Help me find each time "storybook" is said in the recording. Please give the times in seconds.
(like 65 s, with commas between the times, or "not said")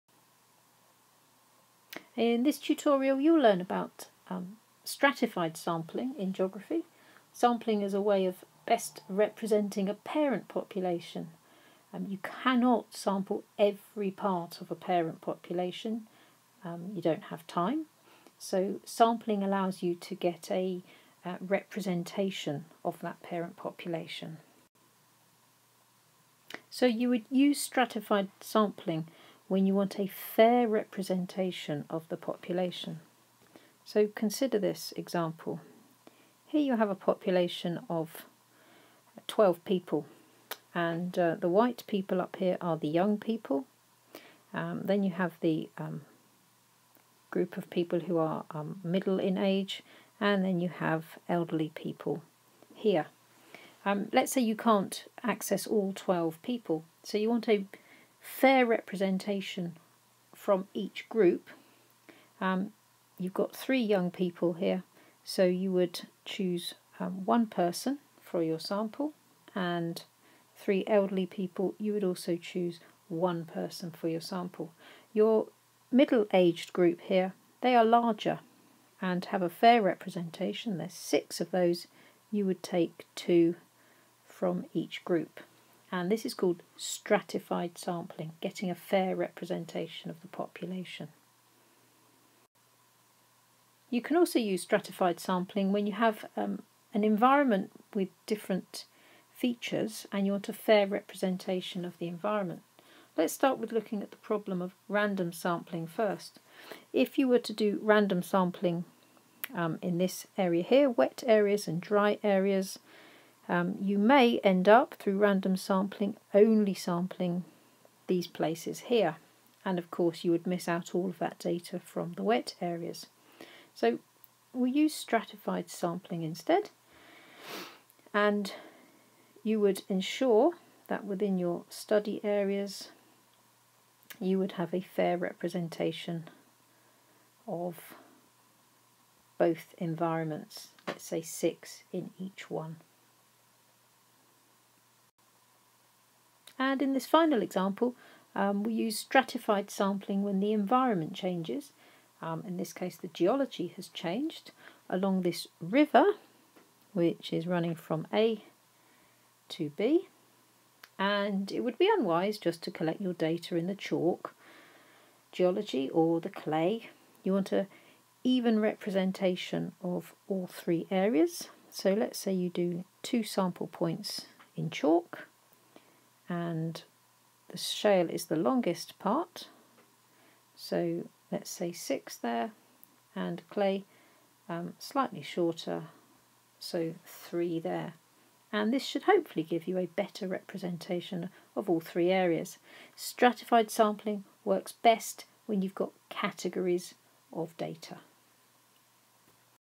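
not said.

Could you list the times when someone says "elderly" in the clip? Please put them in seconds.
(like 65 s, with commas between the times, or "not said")
51 s, 70 s.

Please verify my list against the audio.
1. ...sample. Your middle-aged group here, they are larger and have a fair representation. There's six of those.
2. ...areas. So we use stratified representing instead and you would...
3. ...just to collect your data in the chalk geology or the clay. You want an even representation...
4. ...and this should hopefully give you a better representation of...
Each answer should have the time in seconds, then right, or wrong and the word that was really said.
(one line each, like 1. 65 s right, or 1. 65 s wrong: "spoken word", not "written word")
1. 74 s right
2. 122 s wrong: "sampling", not "representing"
3. 162 s right
4. 188 s right.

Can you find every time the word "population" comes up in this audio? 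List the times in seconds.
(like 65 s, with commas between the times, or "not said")
10 s, 15 s, 23 s, 32 s, 36 s, 90 s.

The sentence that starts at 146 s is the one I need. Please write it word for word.
And in this final example, um, we use stratified sampling when the environment changes.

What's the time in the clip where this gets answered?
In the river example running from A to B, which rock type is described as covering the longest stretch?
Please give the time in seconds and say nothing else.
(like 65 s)
177 s.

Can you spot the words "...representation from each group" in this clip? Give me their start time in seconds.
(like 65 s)
58 s.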